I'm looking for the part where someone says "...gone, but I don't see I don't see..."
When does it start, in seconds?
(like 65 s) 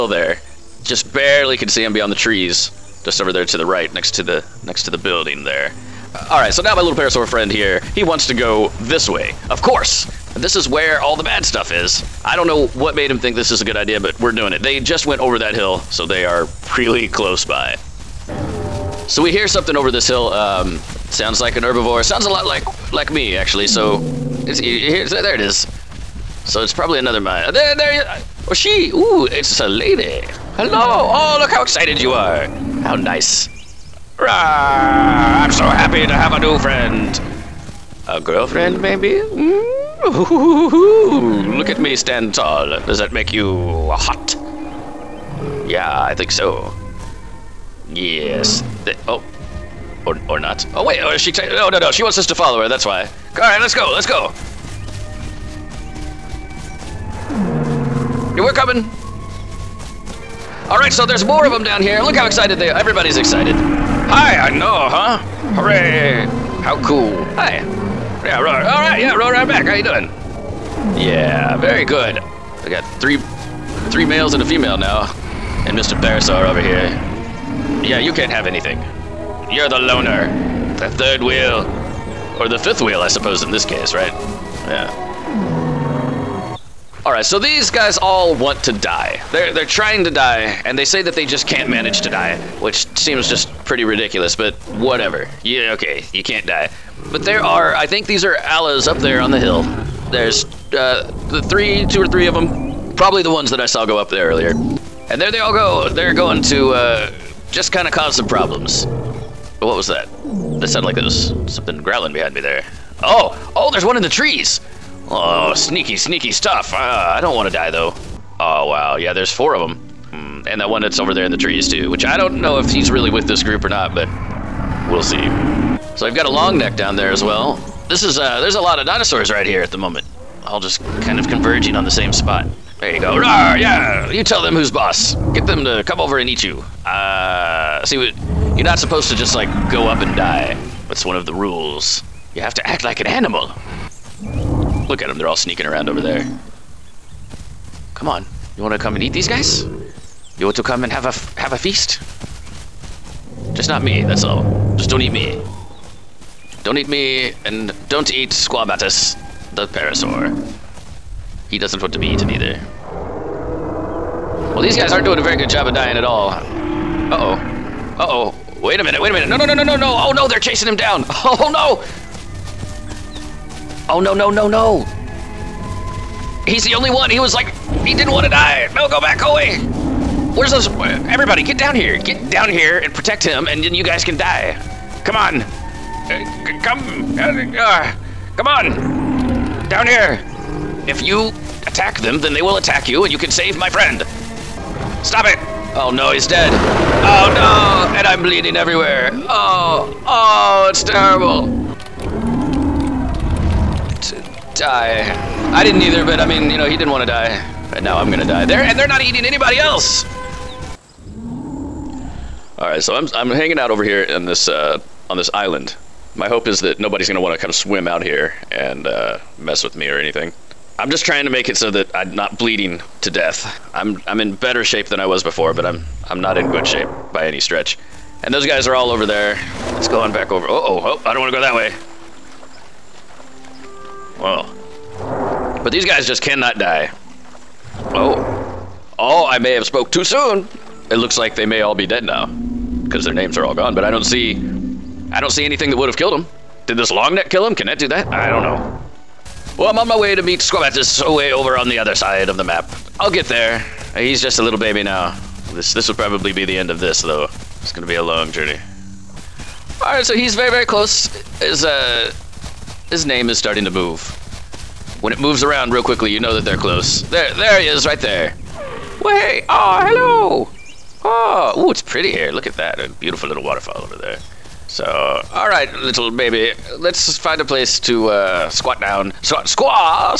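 243 s.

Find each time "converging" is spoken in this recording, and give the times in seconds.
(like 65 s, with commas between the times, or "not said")
131 s.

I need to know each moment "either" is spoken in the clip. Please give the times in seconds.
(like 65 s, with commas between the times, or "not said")
162 s, 205 s.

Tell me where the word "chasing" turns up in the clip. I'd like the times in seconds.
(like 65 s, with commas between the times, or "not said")
170 s.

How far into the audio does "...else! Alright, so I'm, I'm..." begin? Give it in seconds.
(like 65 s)
209 s.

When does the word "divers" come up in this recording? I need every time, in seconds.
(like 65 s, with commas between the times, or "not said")
not said.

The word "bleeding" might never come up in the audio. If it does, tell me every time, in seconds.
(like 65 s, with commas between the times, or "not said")
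198 s, 222 s.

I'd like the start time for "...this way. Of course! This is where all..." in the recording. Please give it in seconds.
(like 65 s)
8 s.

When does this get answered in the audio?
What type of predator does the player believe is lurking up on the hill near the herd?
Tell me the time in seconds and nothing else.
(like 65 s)
98 s.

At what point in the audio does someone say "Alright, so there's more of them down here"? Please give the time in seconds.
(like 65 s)
60 s.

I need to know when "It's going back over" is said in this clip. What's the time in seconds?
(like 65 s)
229 s.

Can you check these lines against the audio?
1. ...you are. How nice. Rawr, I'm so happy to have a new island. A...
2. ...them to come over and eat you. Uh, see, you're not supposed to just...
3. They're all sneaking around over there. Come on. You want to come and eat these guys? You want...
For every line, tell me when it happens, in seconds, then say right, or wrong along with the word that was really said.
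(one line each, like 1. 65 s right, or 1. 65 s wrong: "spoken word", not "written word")
1. 31 s wrong: "friend", not "island"
2. 135 s right
3. 145 s right.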